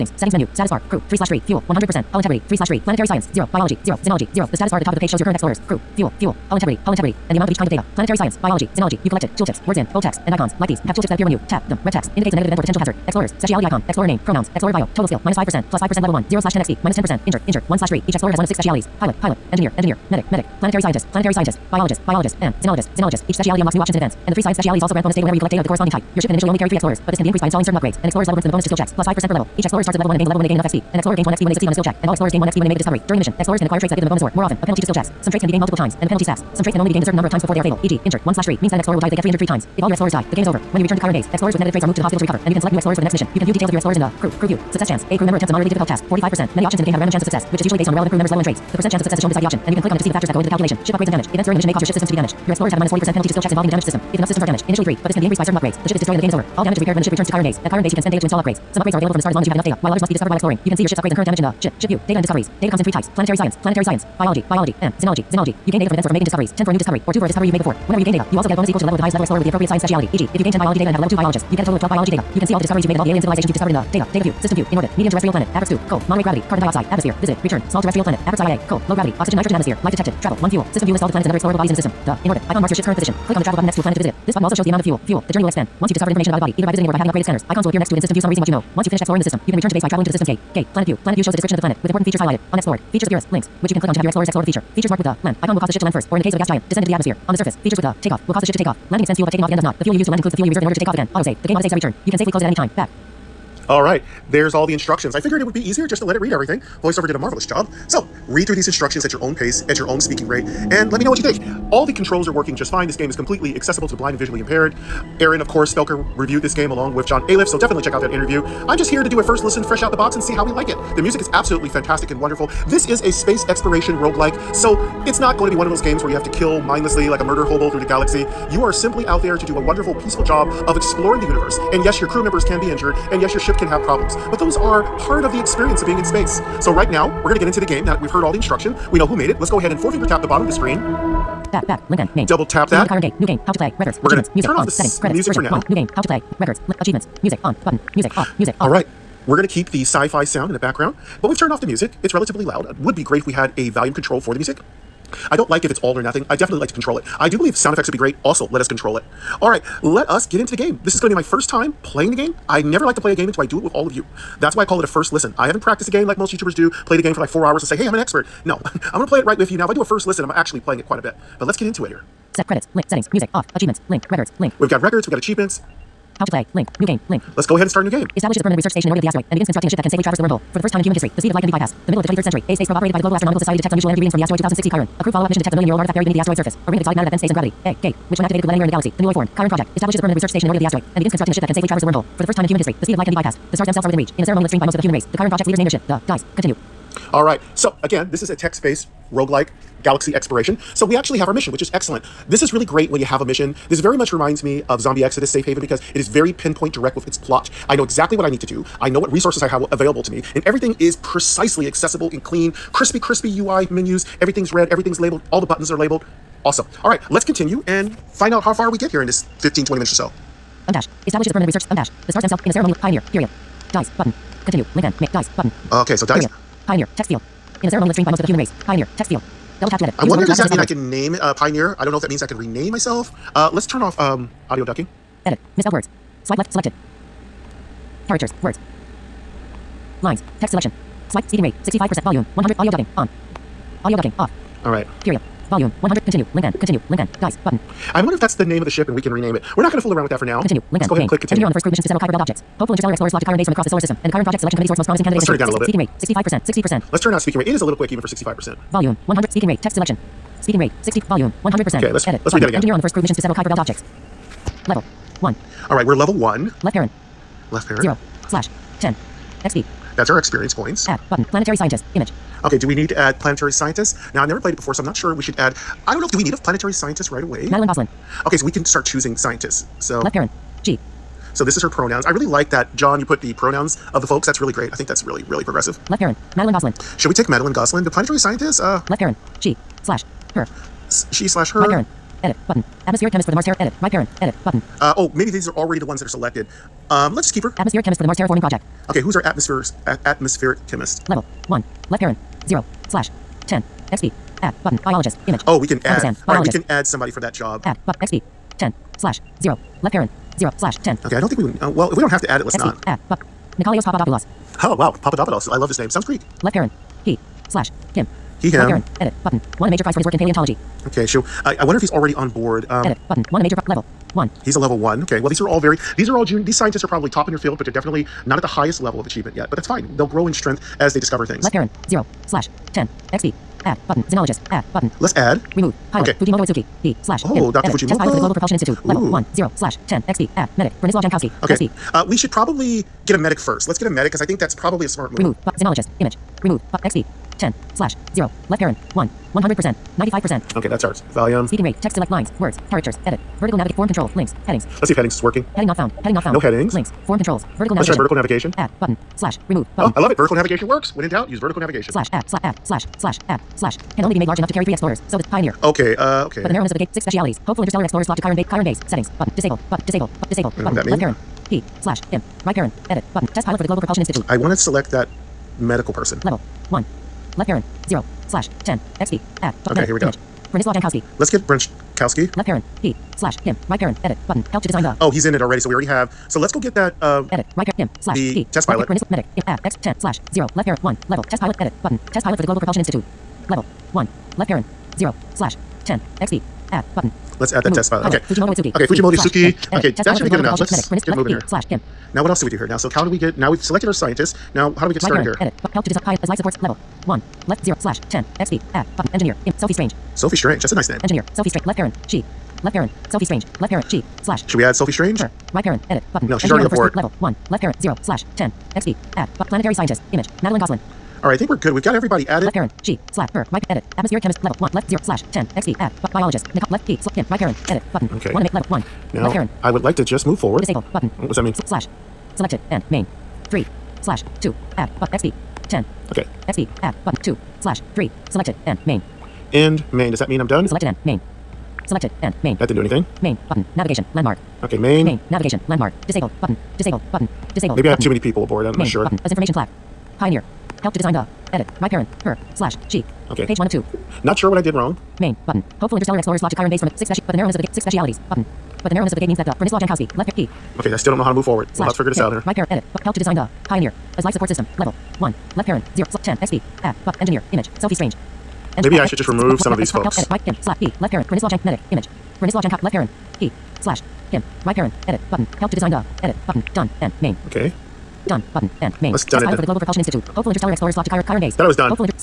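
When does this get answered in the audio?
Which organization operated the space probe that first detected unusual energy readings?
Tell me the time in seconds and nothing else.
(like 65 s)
183 s.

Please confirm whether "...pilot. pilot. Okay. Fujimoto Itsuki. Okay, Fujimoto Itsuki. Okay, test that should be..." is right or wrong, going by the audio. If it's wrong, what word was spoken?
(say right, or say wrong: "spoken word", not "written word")
right.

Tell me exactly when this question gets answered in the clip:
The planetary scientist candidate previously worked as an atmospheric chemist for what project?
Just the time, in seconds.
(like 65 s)
298 s.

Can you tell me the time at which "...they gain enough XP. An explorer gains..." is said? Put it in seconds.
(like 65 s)
30 s.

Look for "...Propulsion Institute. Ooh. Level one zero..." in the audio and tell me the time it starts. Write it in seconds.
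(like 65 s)
338 s.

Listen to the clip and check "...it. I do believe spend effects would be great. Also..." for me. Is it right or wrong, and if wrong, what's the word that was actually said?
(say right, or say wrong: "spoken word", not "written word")
wrong: "sound", not "spend".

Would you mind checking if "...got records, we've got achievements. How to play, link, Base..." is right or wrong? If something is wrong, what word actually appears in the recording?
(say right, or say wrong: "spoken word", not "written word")
wrong: "New", not "Base".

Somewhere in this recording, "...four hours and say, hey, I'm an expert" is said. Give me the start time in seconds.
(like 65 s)
167 s.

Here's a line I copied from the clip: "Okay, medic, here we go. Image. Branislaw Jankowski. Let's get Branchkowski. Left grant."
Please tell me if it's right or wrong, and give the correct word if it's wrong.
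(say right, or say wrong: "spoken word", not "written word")
wrong: "parent", not "grant".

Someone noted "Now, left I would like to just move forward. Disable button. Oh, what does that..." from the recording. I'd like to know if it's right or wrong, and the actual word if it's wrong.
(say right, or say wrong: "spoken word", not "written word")
right.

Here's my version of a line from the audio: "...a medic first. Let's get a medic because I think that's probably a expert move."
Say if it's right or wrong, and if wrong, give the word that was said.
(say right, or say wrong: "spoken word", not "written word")
wrong: "smart", not "expert".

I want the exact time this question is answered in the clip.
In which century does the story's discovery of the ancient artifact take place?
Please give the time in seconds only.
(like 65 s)
182 s.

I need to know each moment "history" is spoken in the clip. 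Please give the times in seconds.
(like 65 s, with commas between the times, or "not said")
180 s, 192 s.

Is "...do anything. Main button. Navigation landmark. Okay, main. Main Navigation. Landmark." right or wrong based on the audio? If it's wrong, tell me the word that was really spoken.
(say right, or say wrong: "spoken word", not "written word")
right.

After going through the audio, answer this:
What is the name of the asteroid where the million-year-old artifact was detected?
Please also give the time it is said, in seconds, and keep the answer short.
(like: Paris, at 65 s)
2060 Chiron, at 184 s.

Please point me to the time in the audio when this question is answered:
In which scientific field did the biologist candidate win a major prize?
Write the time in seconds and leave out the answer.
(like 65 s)
320 s.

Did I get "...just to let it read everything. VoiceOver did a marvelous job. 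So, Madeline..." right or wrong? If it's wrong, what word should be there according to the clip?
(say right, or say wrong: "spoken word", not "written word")
wrong: "Read", not "Madeline".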